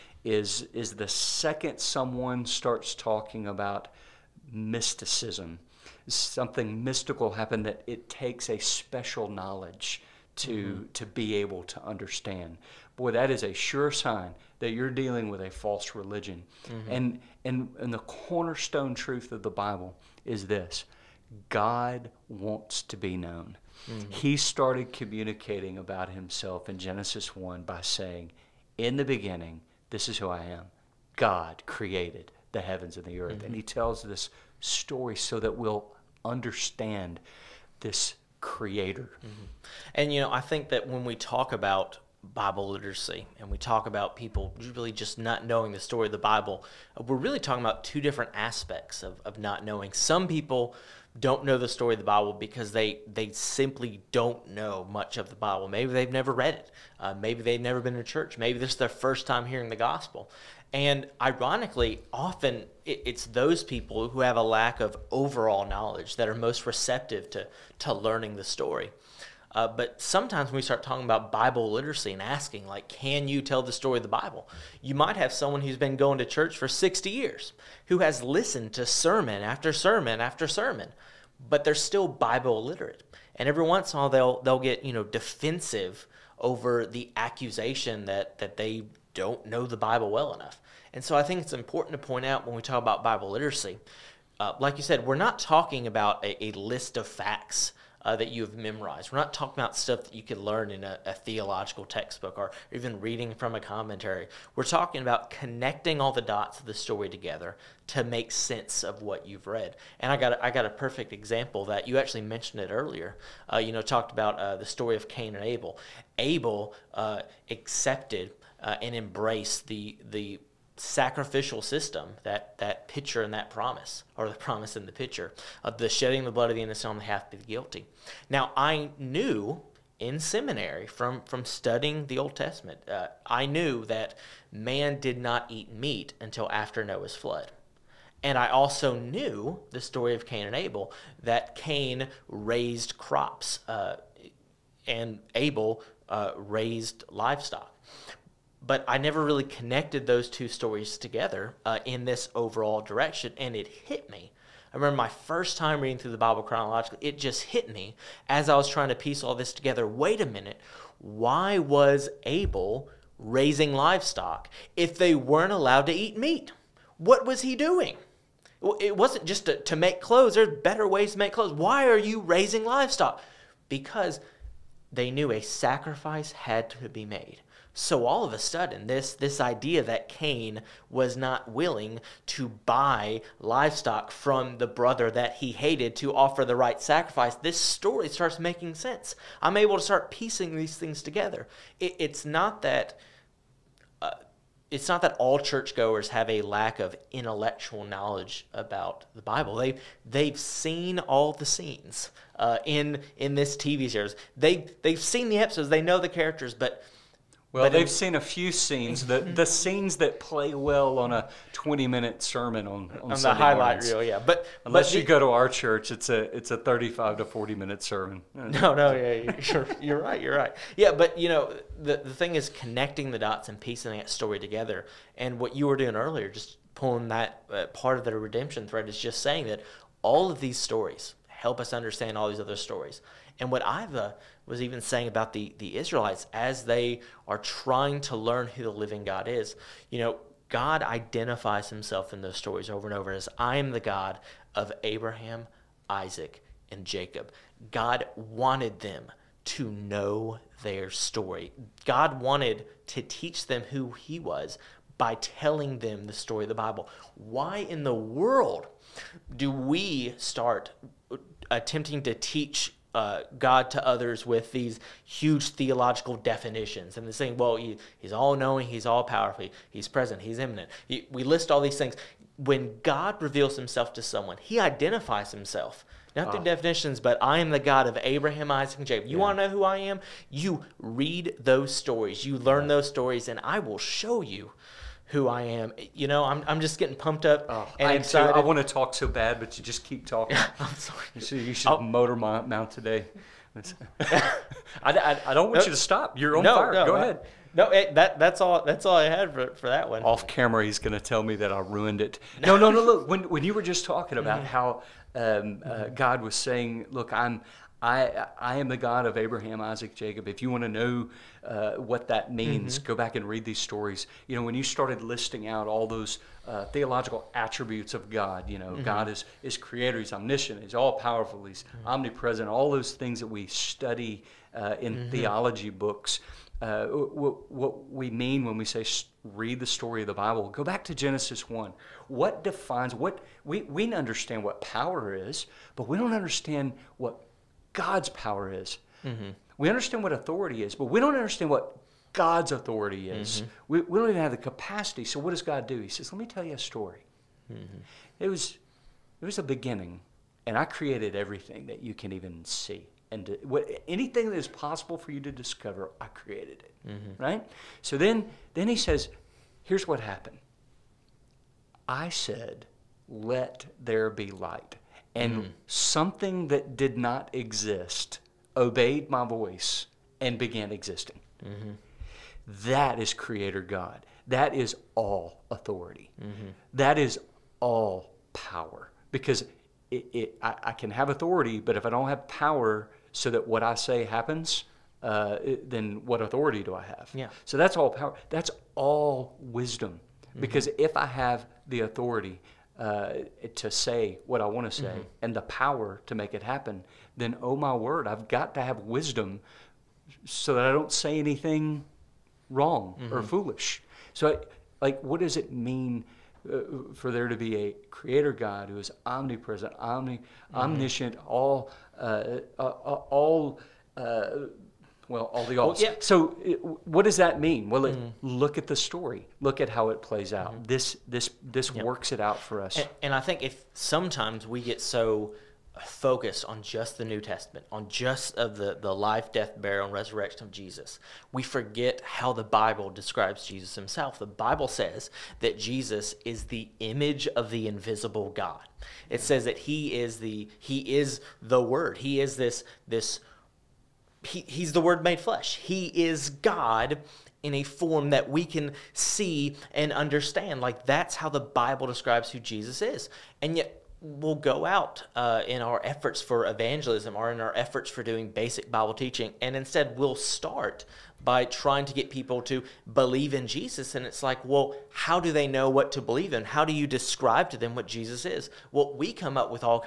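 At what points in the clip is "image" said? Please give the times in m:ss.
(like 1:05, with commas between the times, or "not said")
7:16.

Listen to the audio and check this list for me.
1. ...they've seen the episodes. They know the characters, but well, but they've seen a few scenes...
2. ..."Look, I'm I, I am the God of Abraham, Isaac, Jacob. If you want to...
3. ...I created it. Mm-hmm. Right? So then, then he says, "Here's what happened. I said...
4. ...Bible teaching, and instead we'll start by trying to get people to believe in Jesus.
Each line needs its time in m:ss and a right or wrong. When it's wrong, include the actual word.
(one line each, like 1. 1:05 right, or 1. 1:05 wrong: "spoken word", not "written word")
1. 3:24 right
2. 5:06 right
3. 5:56 right
4. 7:38 right.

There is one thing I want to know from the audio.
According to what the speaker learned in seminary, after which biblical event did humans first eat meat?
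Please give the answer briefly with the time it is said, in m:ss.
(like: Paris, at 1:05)
Noah's flood, at 2:16.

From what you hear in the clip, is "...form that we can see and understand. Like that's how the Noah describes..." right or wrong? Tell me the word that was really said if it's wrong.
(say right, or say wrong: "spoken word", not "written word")
wrong: "Bible", not "Noah".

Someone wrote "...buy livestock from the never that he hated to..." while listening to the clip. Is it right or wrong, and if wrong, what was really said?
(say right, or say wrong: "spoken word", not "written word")
wrong: "brother", not "never".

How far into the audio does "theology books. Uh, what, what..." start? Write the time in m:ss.
5:25.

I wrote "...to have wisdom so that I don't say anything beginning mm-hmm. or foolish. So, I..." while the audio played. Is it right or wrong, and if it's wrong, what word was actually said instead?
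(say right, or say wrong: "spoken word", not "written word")
wrong: "wrong", not "beginning".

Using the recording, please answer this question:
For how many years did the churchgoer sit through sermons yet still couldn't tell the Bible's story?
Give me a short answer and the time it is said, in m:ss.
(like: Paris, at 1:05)
60, at 1:16.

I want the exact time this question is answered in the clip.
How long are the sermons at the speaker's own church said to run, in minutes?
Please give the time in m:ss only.
3:36.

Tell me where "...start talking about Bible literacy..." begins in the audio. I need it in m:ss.
1:10.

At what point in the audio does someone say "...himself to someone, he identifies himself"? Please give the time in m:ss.
4:33.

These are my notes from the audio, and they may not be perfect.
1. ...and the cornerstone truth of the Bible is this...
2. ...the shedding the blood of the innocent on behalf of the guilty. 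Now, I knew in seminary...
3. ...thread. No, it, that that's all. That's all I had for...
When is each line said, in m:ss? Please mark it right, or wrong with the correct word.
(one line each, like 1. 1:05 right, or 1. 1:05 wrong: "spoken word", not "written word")
1. 0:17 right
2. 2:05 right
3. 4:56 wrong: "ahead", not "thread".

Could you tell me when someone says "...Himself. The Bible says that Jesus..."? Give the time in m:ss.
7:13.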